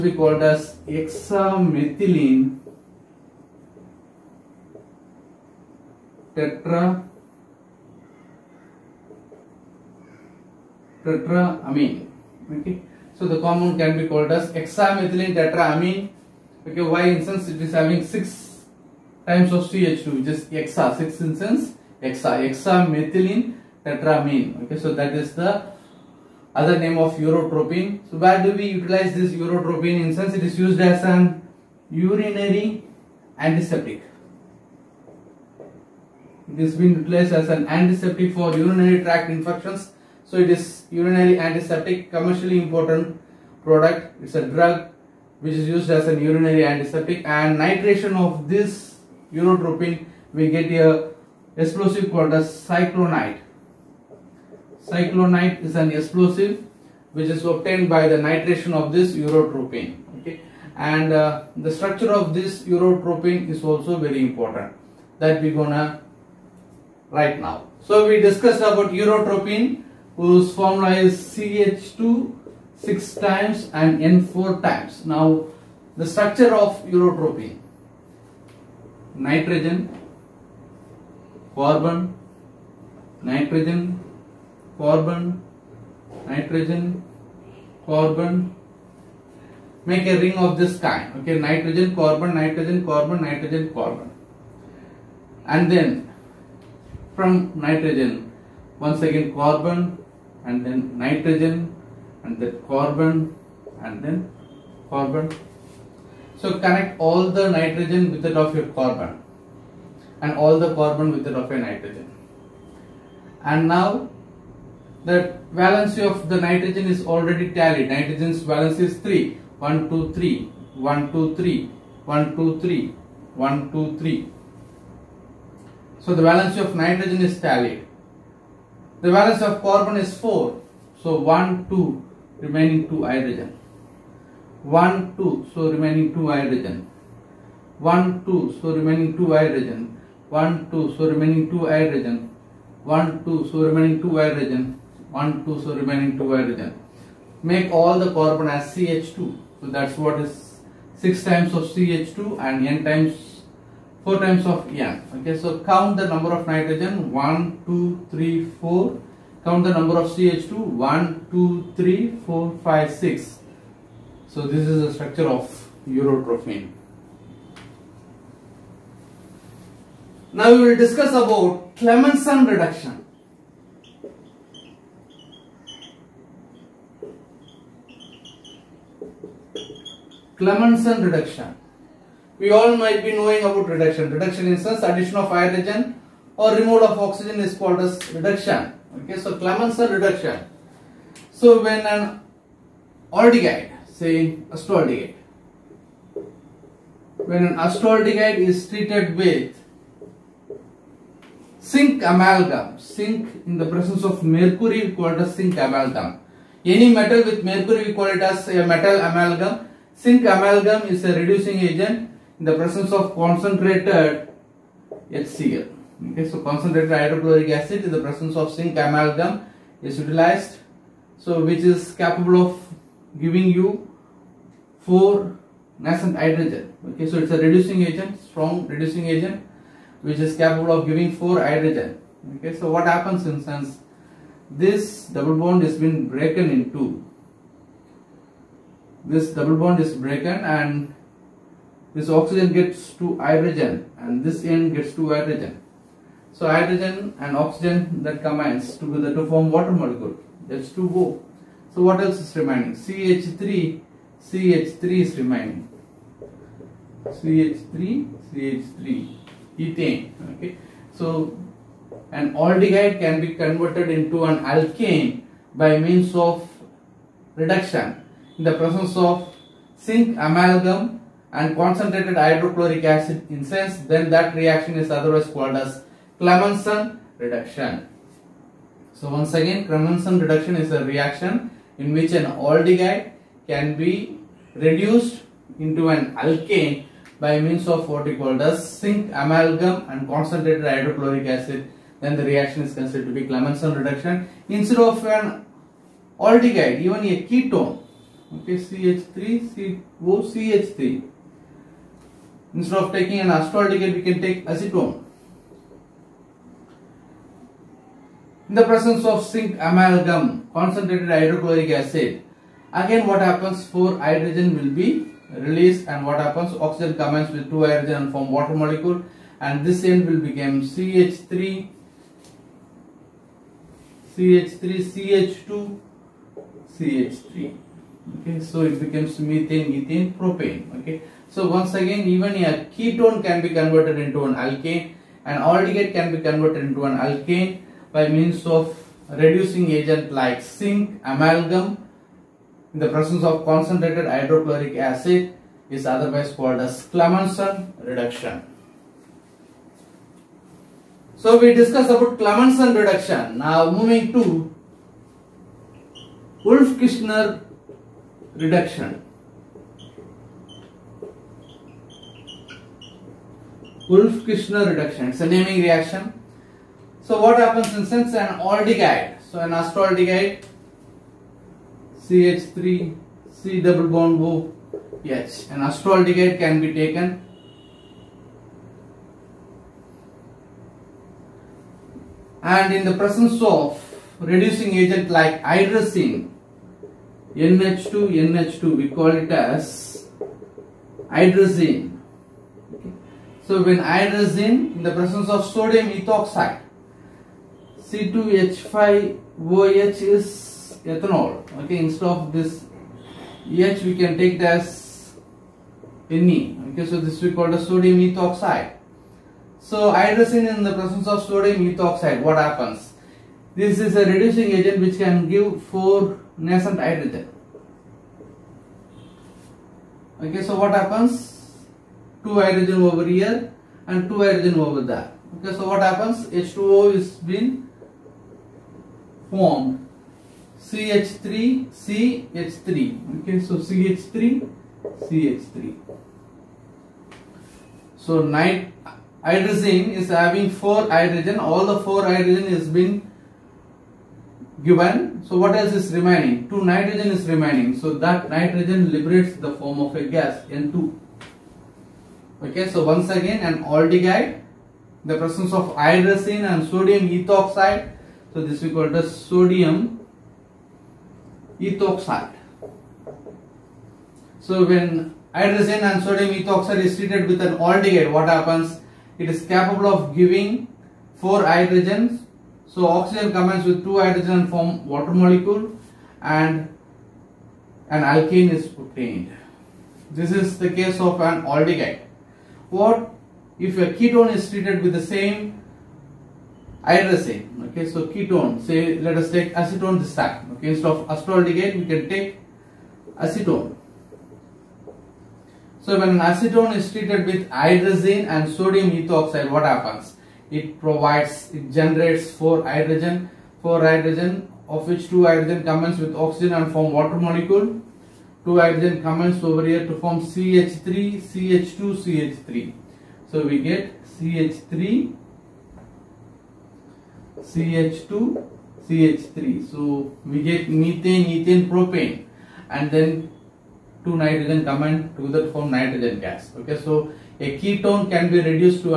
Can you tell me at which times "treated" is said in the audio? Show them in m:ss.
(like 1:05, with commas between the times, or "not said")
3:18, 7:46, 8:04, 8:16.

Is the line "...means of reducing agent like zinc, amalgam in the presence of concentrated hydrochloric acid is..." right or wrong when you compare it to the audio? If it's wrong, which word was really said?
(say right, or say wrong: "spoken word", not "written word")
right.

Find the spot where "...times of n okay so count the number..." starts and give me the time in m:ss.
2:34.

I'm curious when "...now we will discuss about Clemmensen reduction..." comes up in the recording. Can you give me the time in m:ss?
2:50.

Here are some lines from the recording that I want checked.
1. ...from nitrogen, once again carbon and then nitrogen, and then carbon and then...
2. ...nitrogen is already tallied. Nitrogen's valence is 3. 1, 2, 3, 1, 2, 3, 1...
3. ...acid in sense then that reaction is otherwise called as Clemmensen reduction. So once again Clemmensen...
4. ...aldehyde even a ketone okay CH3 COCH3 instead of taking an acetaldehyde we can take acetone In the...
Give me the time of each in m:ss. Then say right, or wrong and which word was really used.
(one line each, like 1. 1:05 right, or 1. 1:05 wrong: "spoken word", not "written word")
1. 1:37 right
2. 1:56 right
3. 4:32 right
4. 4:56 right.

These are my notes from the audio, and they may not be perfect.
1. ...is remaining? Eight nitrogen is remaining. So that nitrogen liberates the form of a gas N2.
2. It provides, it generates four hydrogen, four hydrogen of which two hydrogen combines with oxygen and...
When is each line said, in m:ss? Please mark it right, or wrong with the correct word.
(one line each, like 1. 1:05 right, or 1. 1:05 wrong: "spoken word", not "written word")
1. 7:25 wrong: "Two", not "Eight"
2. 8:20 right.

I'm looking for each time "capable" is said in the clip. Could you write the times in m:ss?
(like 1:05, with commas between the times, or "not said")
3:41, 3:50, 7:49.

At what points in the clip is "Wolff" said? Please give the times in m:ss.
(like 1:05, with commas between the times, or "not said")
5:56, 6:03.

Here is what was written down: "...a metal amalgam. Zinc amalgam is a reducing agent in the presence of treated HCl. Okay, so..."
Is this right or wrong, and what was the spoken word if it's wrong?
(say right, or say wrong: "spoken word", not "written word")
wrong: "concentrated", not "treated".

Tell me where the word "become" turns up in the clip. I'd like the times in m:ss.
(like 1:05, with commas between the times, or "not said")
5:20, 5:28.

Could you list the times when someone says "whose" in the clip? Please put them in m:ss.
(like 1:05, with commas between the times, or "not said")
1:10.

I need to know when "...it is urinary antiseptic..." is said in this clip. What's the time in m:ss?
0:40.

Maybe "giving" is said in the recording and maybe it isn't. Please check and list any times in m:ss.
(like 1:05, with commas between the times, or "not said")
3:43, 3:50, 7:50.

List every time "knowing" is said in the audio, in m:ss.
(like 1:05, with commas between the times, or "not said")
3:03.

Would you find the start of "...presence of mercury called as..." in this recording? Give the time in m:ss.
3:23.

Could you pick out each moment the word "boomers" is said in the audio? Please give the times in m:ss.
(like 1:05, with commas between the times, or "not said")
not said.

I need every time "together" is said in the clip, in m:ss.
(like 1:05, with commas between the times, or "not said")
4:08, 8:45.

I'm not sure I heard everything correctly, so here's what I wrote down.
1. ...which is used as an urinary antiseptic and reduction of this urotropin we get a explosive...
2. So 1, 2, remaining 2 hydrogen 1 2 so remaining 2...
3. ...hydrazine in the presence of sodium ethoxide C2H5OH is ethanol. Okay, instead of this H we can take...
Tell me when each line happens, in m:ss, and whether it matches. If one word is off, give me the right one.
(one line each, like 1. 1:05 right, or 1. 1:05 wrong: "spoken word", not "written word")
1. 0:45 wrong: "nitration", not "reduction"
2. 2:11 right
3. 6:33 right.